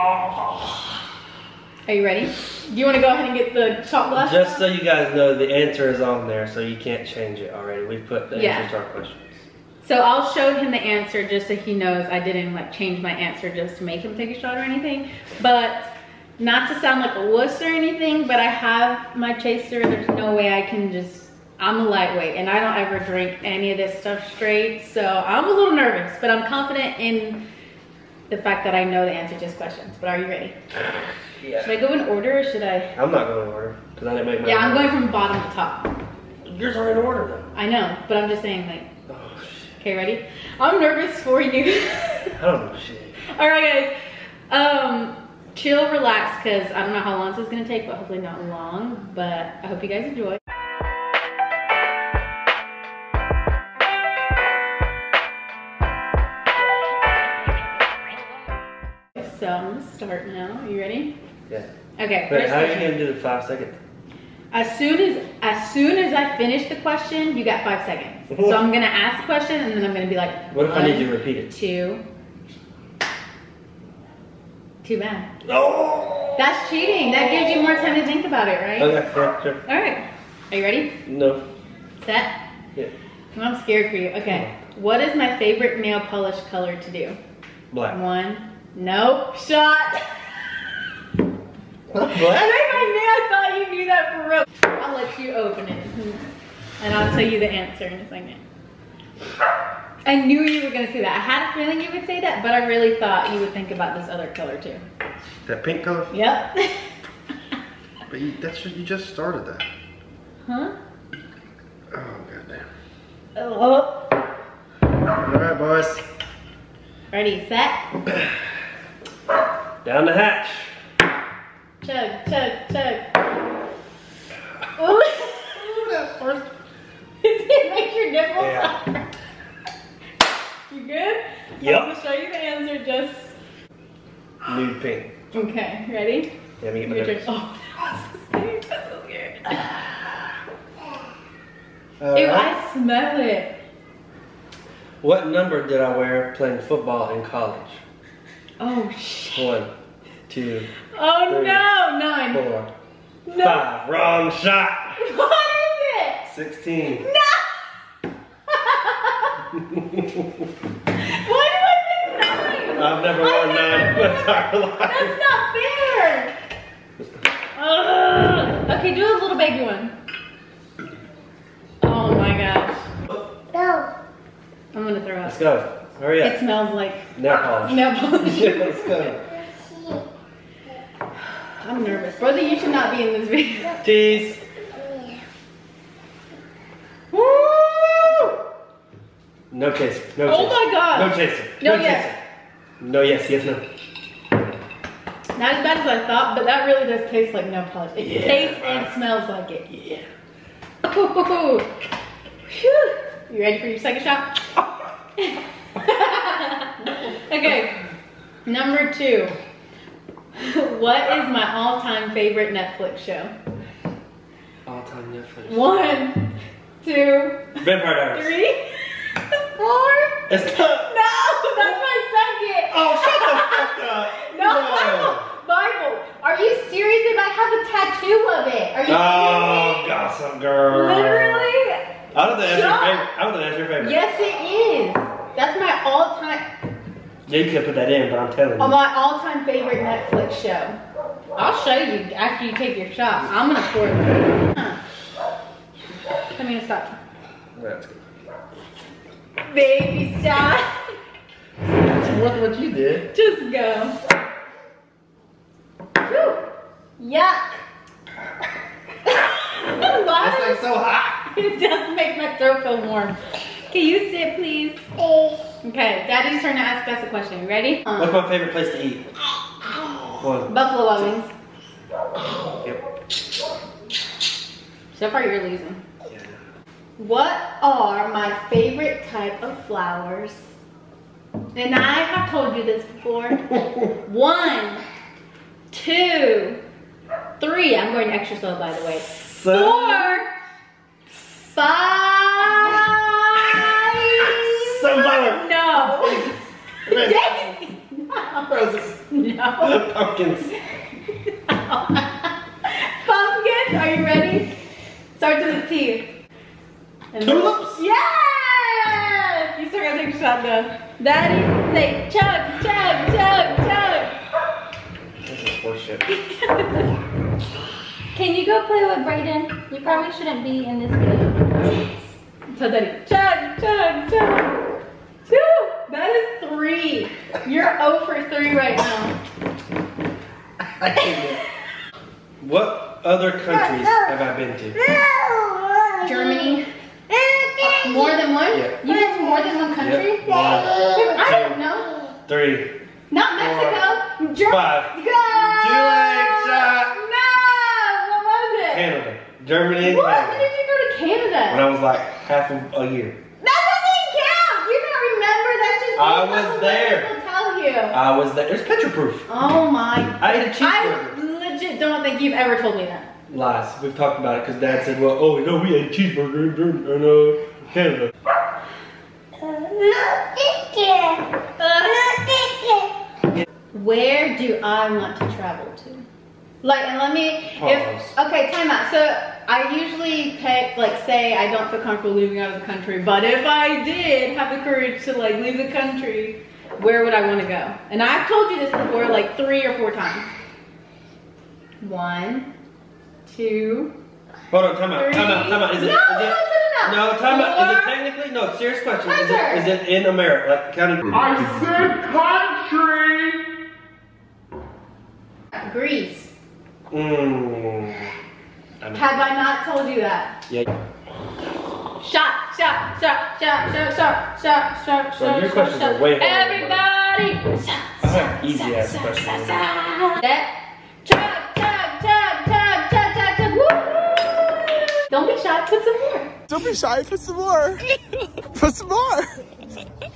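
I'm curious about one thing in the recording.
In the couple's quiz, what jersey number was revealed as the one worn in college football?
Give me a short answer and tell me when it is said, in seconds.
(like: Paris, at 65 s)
16, at 156 s.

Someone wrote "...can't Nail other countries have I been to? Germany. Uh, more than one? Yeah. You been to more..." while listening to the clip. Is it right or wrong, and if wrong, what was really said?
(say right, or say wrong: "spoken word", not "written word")
wrong: "What", not "Nail".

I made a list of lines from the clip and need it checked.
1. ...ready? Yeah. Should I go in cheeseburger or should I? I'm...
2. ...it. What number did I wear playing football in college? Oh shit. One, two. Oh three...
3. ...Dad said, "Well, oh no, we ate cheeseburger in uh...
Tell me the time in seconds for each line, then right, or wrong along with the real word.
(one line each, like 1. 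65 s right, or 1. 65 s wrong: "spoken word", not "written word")
1. 30 s wrong: "order", not "cheeseburger"
2. 143 s right
3. 364 s right.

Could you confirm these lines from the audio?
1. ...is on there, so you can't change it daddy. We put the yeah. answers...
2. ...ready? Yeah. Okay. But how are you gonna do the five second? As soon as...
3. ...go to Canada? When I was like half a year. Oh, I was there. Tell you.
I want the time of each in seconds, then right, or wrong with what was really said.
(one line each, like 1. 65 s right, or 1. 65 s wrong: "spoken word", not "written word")
1. 5 s wrong: "already", not "daddy"
2. 60 s right
3. 350 s right.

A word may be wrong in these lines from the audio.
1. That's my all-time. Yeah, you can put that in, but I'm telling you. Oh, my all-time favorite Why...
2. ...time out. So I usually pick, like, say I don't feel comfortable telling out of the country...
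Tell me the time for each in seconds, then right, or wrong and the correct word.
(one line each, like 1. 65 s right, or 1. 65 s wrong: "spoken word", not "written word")
1. 235 s wrong: "Netflix", not "Why"
2. 378 s wrong: "leaving", not "telling".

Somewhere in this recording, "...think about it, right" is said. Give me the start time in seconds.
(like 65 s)
78 s.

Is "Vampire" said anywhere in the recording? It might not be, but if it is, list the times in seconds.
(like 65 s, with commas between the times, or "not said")
217 s.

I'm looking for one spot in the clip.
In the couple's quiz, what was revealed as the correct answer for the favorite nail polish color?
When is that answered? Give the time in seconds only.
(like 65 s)
134 s.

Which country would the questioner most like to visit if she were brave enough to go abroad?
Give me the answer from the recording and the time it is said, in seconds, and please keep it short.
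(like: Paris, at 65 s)
Greece, at 405 s.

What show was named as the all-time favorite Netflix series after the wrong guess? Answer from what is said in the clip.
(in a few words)
Gossip Girl.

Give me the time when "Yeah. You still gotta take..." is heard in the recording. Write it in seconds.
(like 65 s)
307 s.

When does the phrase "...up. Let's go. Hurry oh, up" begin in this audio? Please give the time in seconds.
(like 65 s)
175 s.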